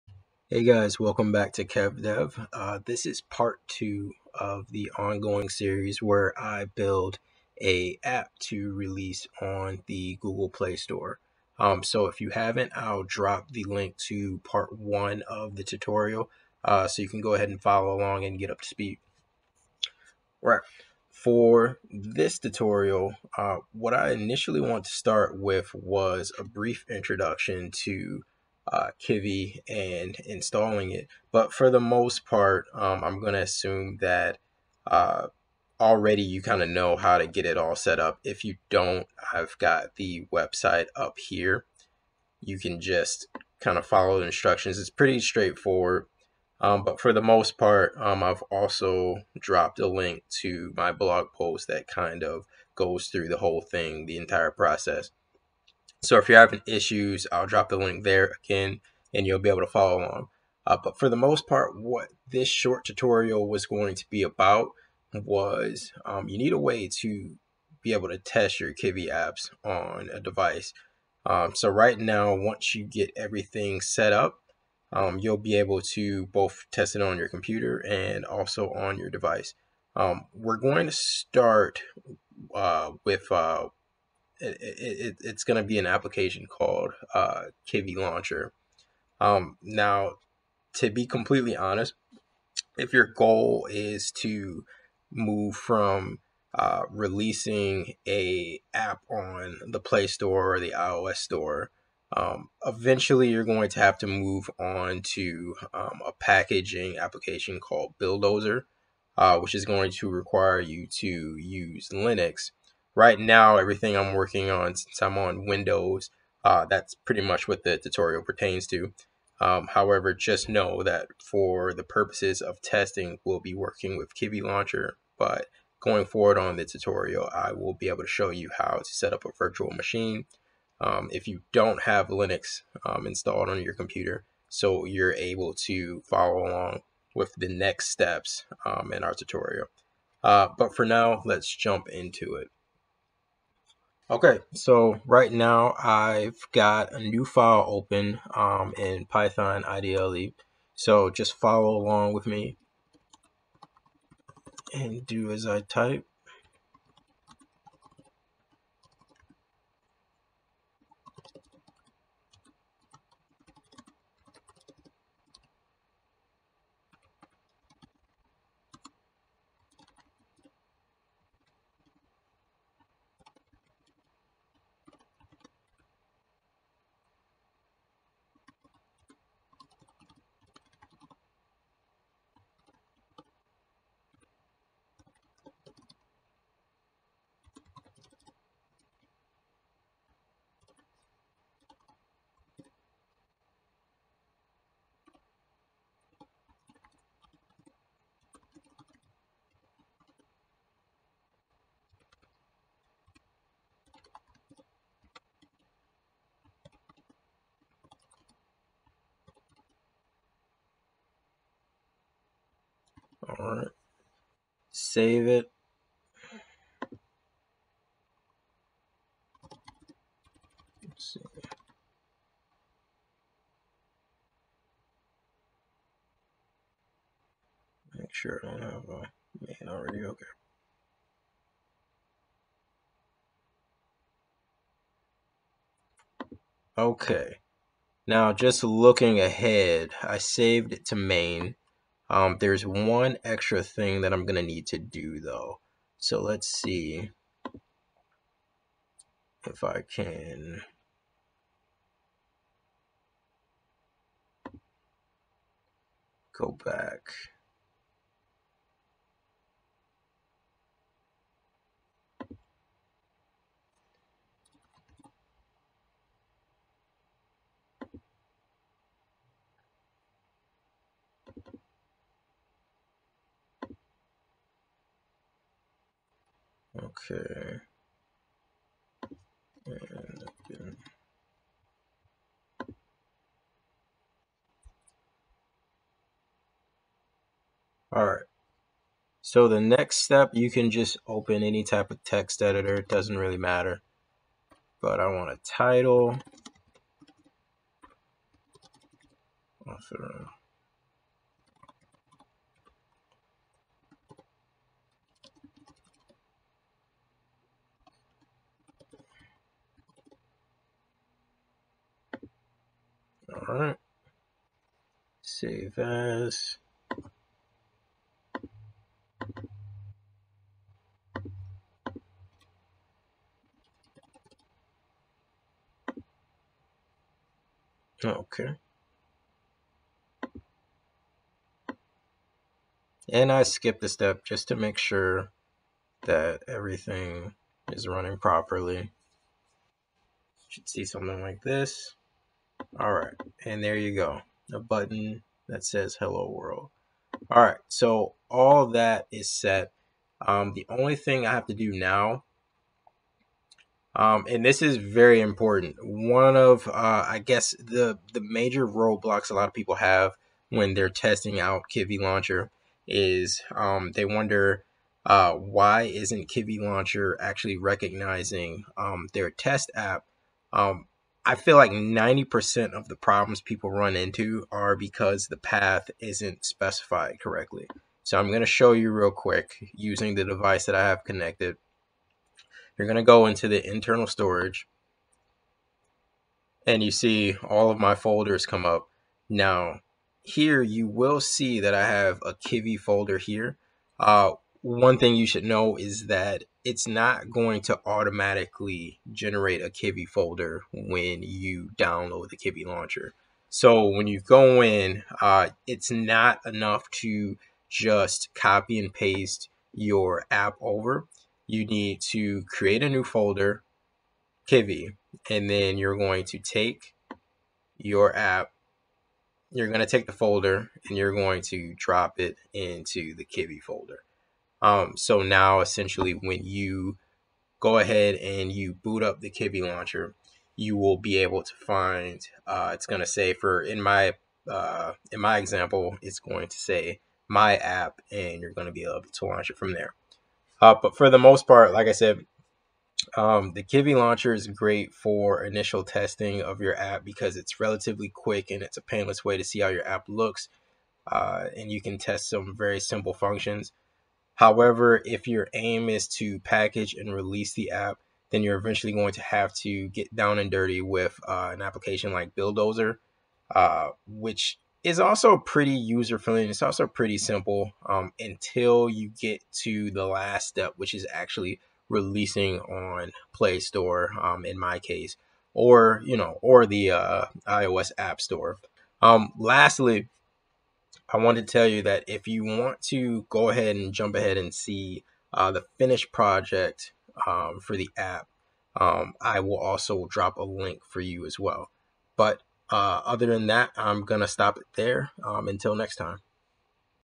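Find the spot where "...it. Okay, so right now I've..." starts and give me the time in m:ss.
2:22.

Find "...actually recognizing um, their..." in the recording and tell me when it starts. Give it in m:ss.
6:07.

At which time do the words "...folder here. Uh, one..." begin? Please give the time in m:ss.
6:32.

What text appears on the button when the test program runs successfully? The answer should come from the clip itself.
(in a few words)
hello world.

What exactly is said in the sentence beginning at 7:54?
Um, in my case, or you know, or the uh, iOS App Store.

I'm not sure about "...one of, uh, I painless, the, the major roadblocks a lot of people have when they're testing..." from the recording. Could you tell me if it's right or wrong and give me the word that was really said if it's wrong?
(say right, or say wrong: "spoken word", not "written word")
wrong: "guess", not "painless".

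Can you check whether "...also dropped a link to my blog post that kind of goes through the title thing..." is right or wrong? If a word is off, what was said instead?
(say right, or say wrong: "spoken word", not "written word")
wrong: "whole", not "title".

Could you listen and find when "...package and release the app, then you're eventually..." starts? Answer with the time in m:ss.
7:36.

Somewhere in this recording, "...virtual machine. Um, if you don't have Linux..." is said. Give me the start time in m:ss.
2:09.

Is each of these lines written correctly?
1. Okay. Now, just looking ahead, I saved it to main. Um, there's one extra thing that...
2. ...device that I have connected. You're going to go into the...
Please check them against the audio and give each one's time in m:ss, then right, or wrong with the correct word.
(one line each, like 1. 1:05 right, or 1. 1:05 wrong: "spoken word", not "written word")
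1. 3:56 right
2. 6:20 right.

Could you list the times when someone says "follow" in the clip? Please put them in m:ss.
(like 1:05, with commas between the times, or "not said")
0:17, 0:43, 0:59, 2:16, 2:31.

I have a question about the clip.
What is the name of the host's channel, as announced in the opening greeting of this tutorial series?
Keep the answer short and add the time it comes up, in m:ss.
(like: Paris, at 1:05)
KevDev, at 0:01.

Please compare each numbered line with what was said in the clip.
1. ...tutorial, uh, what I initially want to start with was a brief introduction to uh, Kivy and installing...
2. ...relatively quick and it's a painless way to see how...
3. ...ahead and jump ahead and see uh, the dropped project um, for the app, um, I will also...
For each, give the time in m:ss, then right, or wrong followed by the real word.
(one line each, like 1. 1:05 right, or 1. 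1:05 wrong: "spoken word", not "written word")
1. 0:22 right
2. 7:27 right
3. 8:03 wrong: "finished", not "dropped".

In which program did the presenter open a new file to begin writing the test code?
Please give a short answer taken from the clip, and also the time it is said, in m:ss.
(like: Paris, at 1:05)
Python IDLE, at 2:29.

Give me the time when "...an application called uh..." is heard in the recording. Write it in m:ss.
1:25.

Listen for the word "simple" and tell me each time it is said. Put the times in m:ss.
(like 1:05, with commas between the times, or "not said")
7:32, 7:47.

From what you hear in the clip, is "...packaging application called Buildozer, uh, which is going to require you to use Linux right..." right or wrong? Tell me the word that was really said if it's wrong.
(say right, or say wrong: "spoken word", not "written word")
right.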